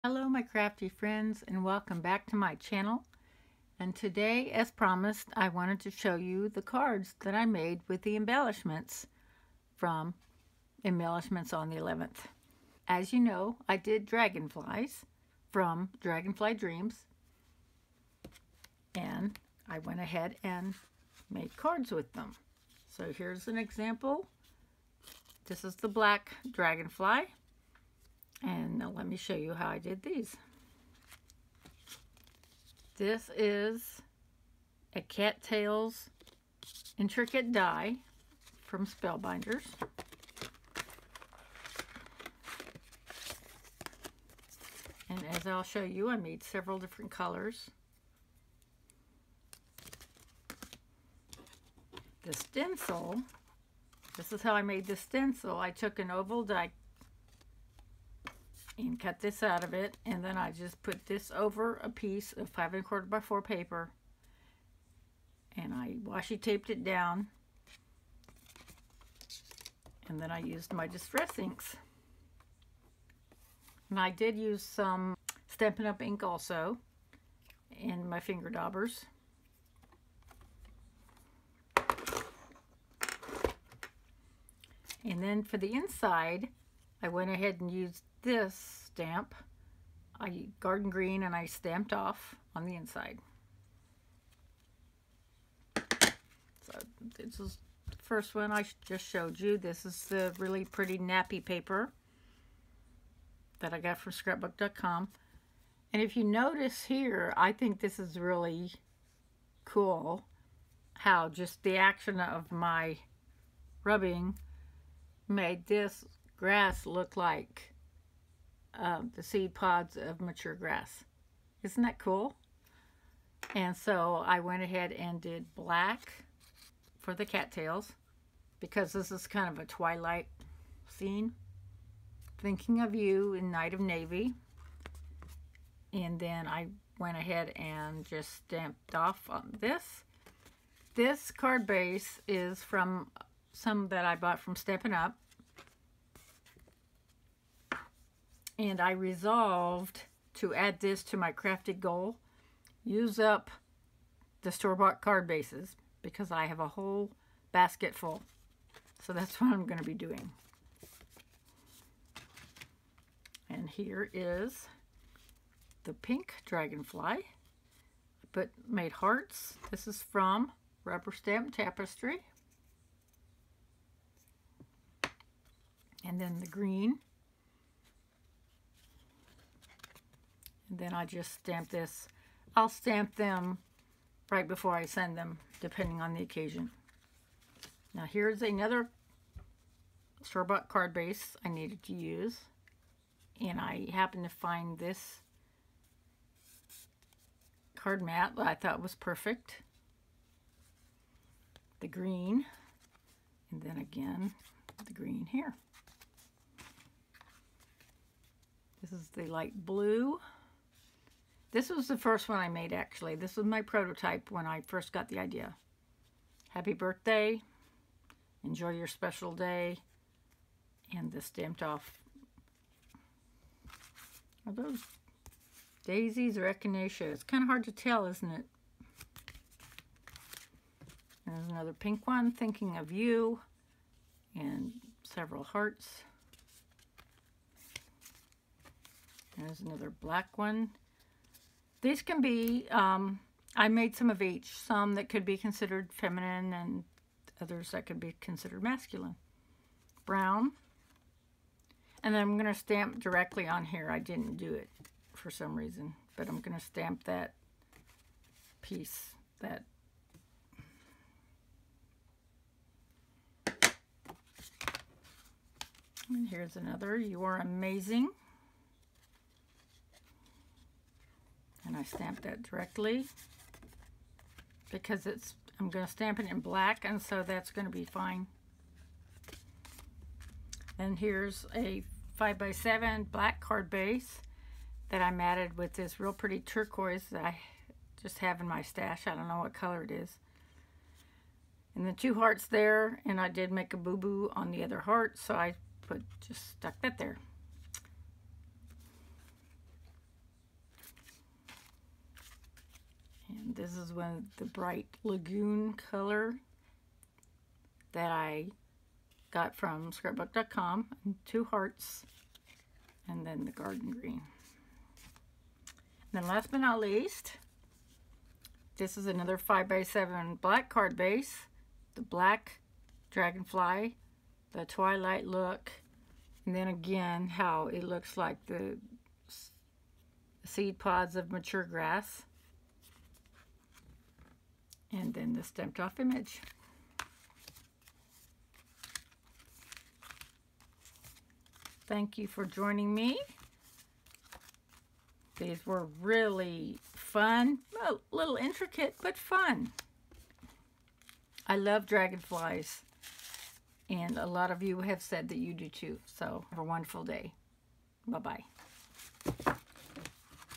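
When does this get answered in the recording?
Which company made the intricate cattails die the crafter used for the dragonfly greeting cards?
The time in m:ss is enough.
0:38.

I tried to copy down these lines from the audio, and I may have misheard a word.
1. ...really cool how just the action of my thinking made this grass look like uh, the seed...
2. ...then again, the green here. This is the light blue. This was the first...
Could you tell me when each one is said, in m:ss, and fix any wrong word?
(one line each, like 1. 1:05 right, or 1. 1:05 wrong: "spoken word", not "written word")
1. 1:48 wrong: "rubbing", not "thinking"
2. 3:23 right.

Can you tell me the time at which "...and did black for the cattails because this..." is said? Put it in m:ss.
2:04.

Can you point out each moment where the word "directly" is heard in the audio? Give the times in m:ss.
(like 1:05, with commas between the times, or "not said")
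4:13, 4:32.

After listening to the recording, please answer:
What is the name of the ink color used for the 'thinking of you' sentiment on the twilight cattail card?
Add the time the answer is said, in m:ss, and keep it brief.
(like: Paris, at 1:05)
Night of Navy, at 2:13.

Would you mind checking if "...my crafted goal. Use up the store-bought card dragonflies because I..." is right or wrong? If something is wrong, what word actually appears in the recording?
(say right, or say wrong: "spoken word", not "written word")
wrong: "bases", not "dragonflies".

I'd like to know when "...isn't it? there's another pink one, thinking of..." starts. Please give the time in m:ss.
3:48.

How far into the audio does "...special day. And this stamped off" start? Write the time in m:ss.
3:38.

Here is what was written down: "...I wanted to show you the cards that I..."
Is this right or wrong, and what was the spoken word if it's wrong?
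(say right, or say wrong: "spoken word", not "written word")
right.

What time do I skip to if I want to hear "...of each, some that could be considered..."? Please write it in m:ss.
4:04.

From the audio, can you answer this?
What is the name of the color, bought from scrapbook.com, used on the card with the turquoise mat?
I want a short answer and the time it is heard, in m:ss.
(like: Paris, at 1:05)
Bright Lagoon, at 5:04.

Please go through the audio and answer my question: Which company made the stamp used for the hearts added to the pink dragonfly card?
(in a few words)
Rubber Stamp Tapestry.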